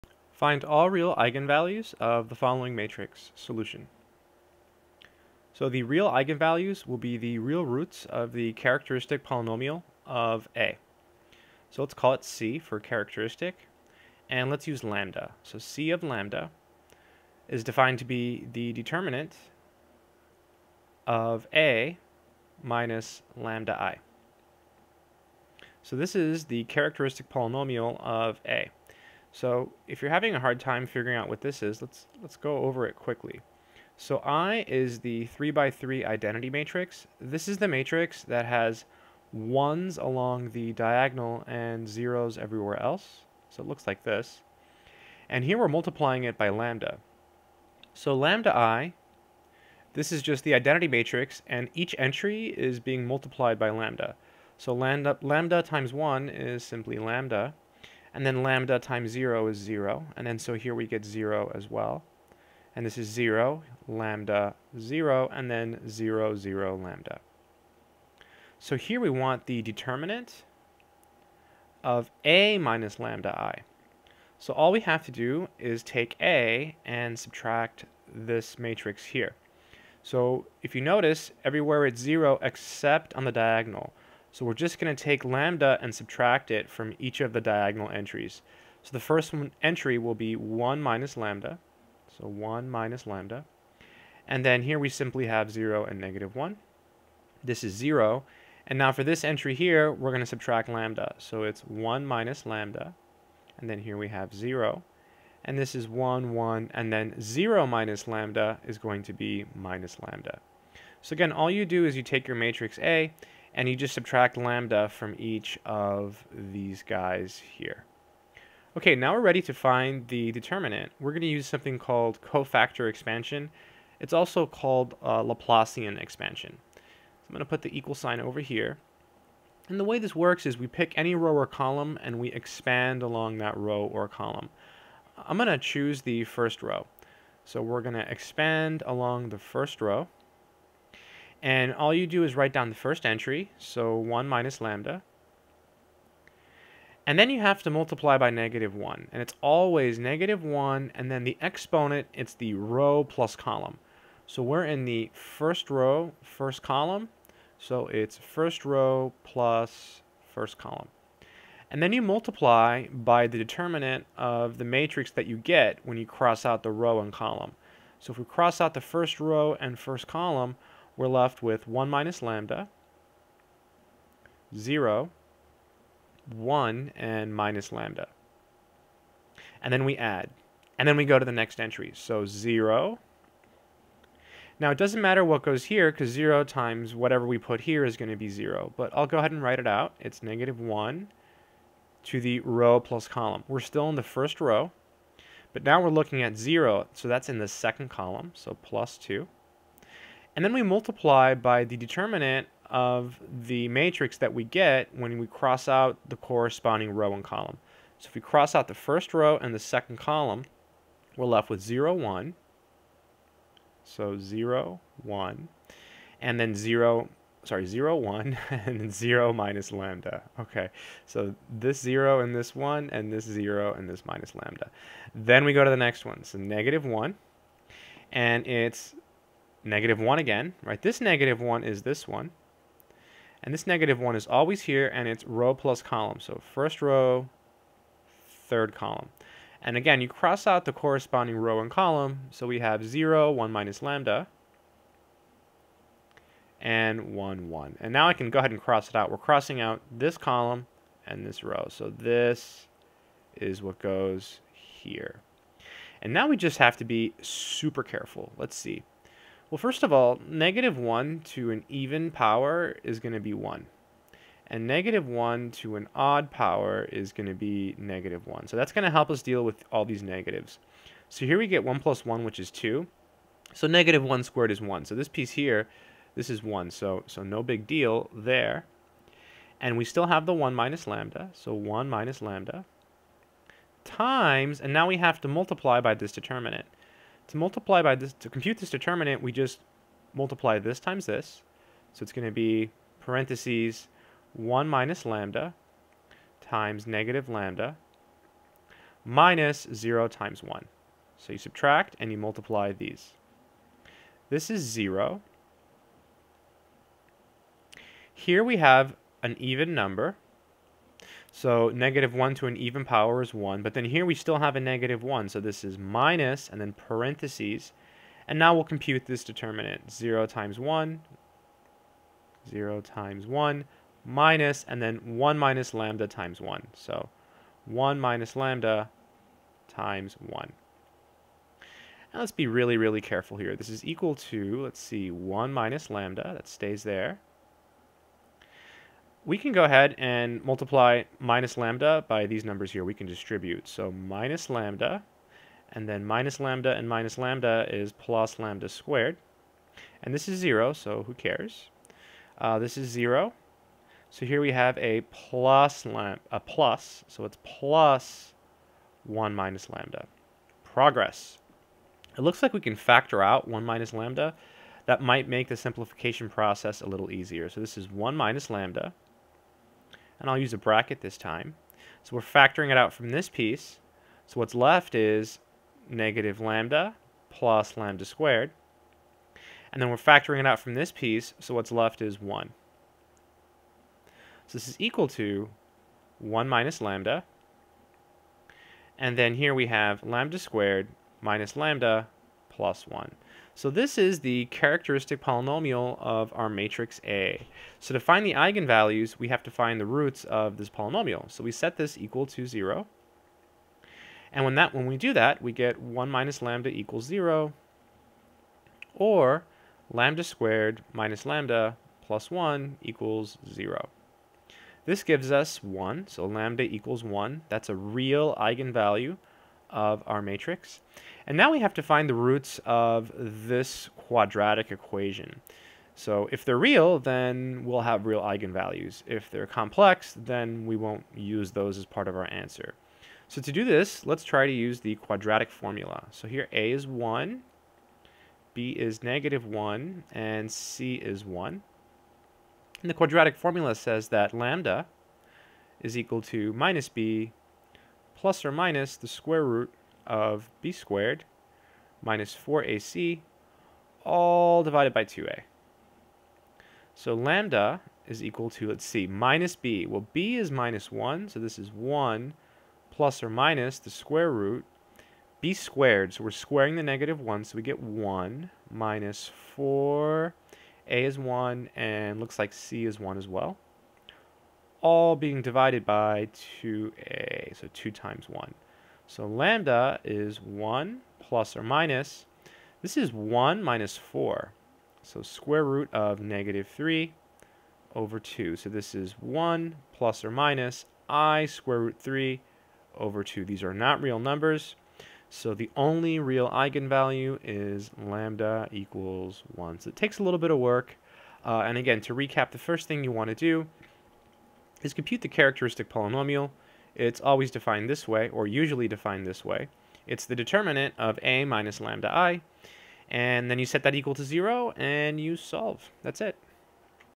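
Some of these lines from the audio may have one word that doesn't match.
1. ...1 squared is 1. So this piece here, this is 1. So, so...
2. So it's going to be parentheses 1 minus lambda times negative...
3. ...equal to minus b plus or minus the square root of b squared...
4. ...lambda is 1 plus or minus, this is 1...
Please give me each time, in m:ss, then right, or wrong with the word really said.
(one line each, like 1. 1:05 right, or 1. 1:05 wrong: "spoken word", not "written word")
1. 4:34 right
2. 4:51 right
3. 7:25 right
4. 7:59 right.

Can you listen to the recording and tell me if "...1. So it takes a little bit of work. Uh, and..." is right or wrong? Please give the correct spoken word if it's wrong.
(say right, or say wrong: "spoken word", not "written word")
right.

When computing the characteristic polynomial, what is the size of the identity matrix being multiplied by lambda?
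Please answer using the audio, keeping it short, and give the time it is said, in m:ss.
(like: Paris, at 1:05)
3 by 3, at 0:35.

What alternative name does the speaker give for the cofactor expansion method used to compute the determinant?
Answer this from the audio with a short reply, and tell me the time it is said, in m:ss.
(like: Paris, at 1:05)
Laplacian expansion, at 2:05.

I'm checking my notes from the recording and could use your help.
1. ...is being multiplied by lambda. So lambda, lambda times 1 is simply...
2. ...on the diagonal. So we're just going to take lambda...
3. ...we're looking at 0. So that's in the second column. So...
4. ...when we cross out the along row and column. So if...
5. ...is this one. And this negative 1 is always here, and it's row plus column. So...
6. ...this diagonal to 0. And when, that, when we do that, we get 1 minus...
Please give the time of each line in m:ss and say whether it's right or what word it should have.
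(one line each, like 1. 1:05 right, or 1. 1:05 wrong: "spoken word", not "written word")
1. 0:52 right
2. 1:23 right
3. 3:15 right
4. 3:24 wrong: "corresponding", not "along"
5. 3:51 right
6. 6:41 wrong: "equal", not "diagonal".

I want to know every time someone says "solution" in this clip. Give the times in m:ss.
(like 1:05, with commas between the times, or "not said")
0:03.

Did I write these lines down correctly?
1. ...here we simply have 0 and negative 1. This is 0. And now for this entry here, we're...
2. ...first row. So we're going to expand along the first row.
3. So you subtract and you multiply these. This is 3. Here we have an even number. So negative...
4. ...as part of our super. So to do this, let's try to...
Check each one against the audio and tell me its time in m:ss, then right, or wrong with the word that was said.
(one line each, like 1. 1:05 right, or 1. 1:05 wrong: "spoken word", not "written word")
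1. 1:34 right
2. 2:16 right
3. 5:01 wrong: "0", not "3"
4. 7:11 wrong: "answer", not "super".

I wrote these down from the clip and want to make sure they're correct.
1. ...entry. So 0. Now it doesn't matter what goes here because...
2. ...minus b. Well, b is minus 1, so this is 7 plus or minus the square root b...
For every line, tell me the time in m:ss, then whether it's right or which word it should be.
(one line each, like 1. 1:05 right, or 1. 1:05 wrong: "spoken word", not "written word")
1. 3:01 right
2. 7:39 wrong: "1", not "7".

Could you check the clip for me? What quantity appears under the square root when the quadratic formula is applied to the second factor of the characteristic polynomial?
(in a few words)
-3.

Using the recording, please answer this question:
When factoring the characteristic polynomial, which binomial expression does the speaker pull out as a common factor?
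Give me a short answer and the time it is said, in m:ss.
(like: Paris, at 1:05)
1 minus lambda, at 6:02.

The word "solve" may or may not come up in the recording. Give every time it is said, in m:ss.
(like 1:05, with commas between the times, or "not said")
8:35.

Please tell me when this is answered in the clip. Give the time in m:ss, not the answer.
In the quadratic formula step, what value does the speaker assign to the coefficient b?
7:18.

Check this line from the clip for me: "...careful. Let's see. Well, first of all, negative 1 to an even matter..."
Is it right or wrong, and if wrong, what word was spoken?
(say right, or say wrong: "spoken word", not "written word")
wrong: "power", not "matter".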